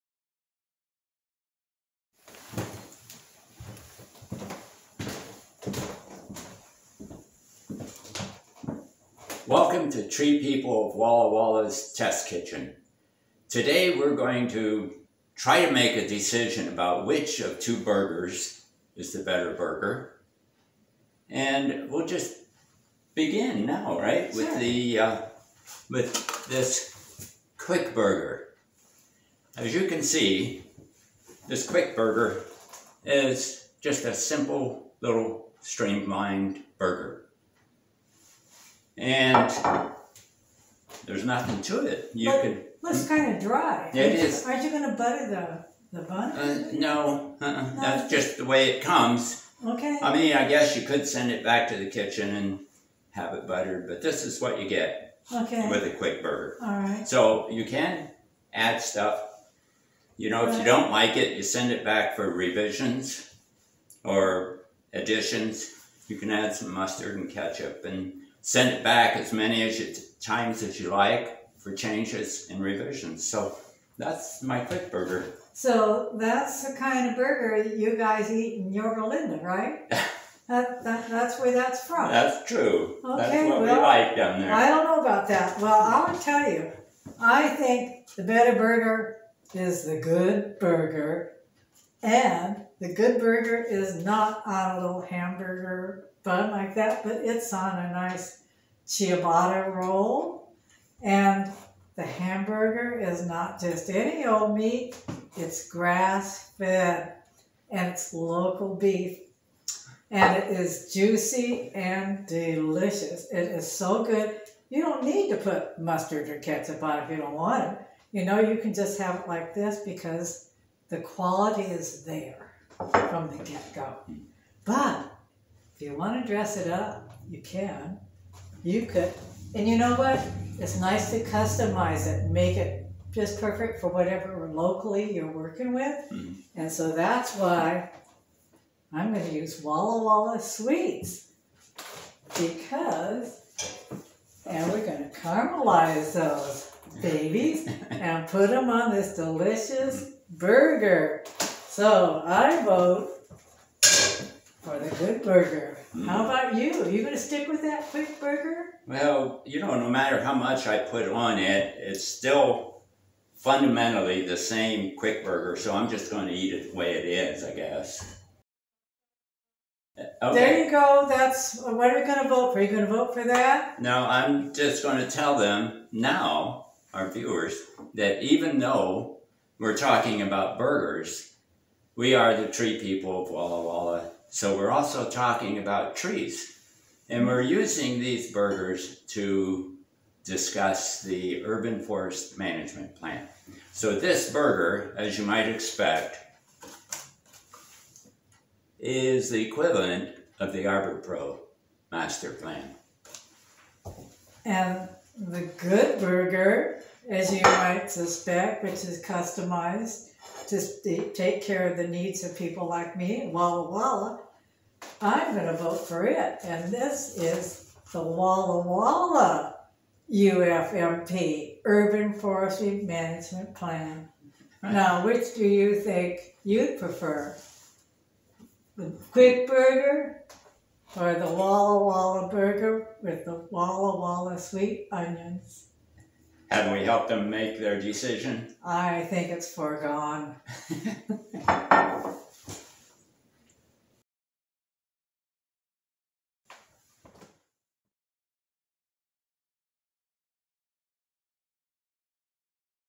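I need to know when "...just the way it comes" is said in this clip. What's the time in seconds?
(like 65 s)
48 s.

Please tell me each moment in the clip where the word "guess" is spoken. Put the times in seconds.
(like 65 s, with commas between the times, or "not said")
50 s, 167 s.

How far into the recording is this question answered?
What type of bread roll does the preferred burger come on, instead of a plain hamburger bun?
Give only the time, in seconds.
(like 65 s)
98 s.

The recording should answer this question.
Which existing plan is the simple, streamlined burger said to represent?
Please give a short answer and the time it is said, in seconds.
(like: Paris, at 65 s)
Arbor Pro master plan, at 200 s.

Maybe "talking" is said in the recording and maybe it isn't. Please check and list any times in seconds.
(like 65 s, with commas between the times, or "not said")
179 s, 185 s.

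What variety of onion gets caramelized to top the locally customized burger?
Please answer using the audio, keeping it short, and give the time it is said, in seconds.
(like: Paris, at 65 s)
Walla Walla Sweets, at 139 s.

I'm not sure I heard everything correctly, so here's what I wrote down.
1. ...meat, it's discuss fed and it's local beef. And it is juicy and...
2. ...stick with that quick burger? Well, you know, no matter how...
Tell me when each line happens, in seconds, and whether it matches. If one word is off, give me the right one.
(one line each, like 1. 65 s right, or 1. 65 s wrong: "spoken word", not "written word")
1. 104 s wrong: "grass", not "discuss"
2. 157 s right.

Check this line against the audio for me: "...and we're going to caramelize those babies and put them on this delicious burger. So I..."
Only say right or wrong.
right.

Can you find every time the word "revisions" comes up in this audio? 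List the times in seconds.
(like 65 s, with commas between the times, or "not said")
62 s, 72 s.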